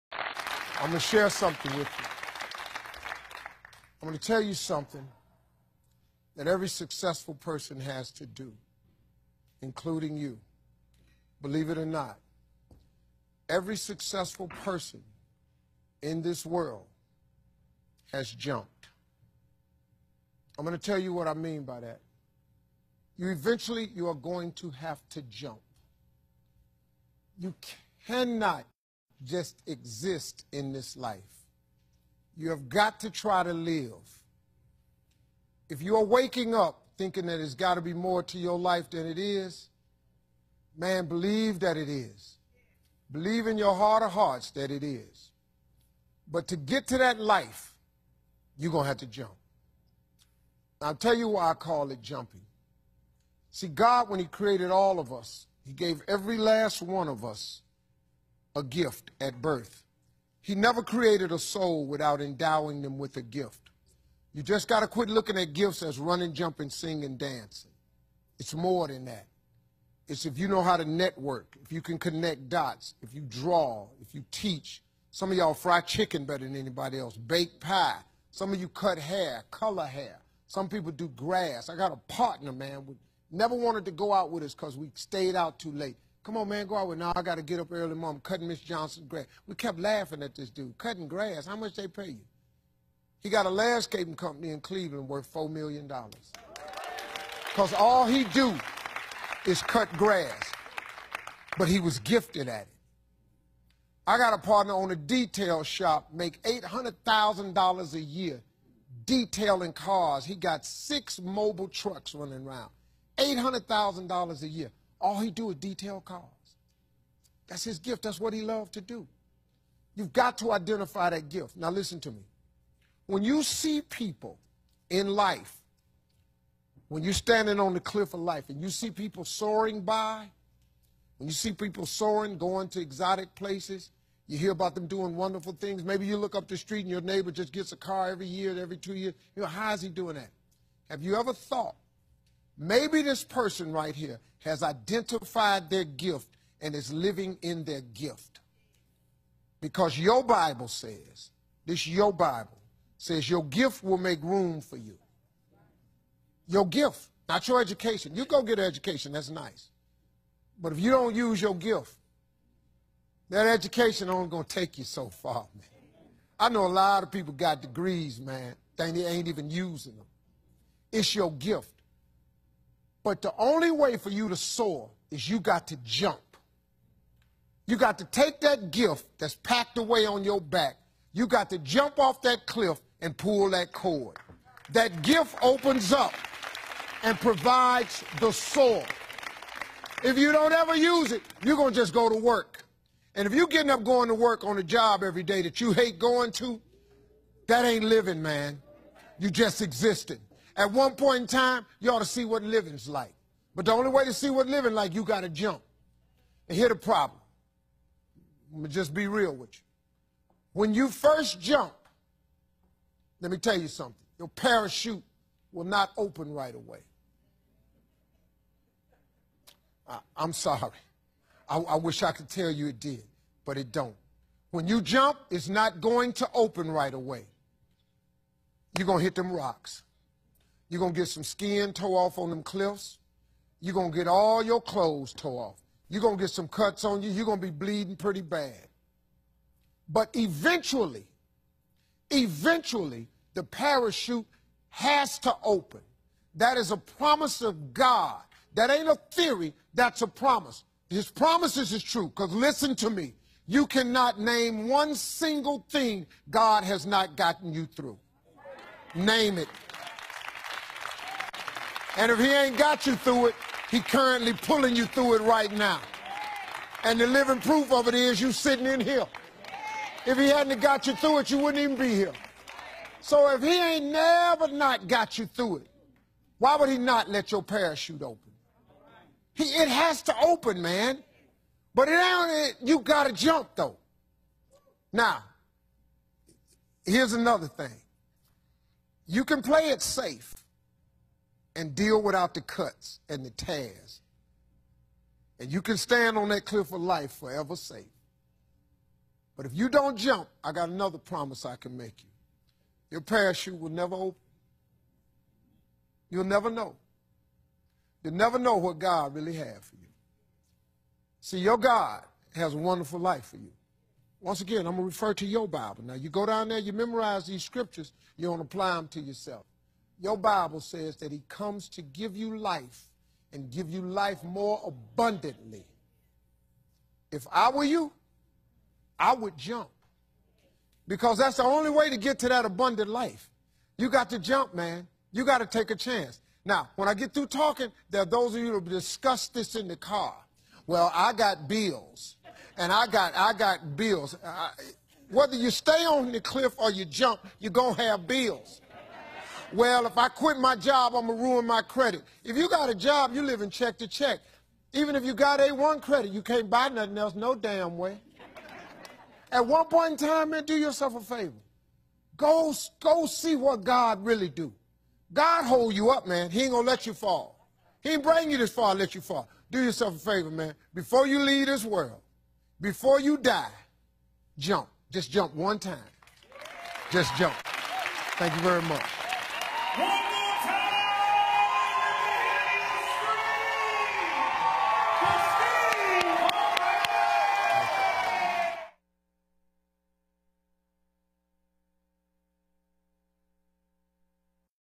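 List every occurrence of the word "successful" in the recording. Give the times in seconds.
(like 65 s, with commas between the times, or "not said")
6 s, 13 s.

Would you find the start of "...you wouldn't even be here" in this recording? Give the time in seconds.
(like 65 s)
271 s.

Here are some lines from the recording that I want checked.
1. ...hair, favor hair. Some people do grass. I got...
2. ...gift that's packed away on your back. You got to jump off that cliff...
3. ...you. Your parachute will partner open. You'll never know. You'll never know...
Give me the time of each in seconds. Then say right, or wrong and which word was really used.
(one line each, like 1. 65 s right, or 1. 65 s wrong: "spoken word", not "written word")
1. 78 s wrong: "color", not "favor"
2. 178 s right
3. 302 s wrong: "never", not "partner".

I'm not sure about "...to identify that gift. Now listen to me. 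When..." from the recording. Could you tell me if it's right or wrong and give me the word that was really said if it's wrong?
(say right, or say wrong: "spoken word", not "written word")
right.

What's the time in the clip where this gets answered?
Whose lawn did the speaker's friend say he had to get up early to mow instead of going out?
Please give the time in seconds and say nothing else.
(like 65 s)
88 s.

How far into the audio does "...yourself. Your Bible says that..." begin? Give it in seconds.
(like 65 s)
318 s.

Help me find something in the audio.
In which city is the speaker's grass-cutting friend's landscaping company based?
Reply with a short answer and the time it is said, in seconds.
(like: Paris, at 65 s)
Cleveland, at 94 s.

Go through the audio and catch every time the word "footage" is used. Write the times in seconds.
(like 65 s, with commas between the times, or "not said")
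not said.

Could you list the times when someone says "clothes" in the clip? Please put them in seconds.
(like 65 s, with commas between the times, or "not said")
234 s.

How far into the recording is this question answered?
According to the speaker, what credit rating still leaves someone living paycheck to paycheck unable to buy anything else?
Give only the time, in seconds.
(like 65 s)
355 s.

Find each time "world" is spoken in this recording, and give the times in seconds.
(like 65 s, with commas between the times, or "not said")
16 s, 371 s.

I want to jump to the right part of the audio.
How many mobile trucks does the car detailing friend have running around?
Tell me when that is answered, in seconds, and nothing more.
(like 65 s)
110 s.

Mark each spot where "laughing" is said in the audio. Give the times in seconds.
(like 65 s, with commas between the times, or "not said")
89 s.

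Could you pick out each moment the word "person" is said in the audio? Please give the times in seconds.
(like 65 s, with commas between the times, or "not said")
7 s, 14 s, 143 s.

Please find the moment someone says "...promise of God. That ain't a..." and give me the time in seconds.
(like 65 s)
246 s.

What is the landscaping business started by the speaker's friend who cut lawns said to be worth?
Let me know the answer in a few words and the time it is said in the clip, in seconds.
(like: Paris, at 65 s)
$4 million, at 95 s.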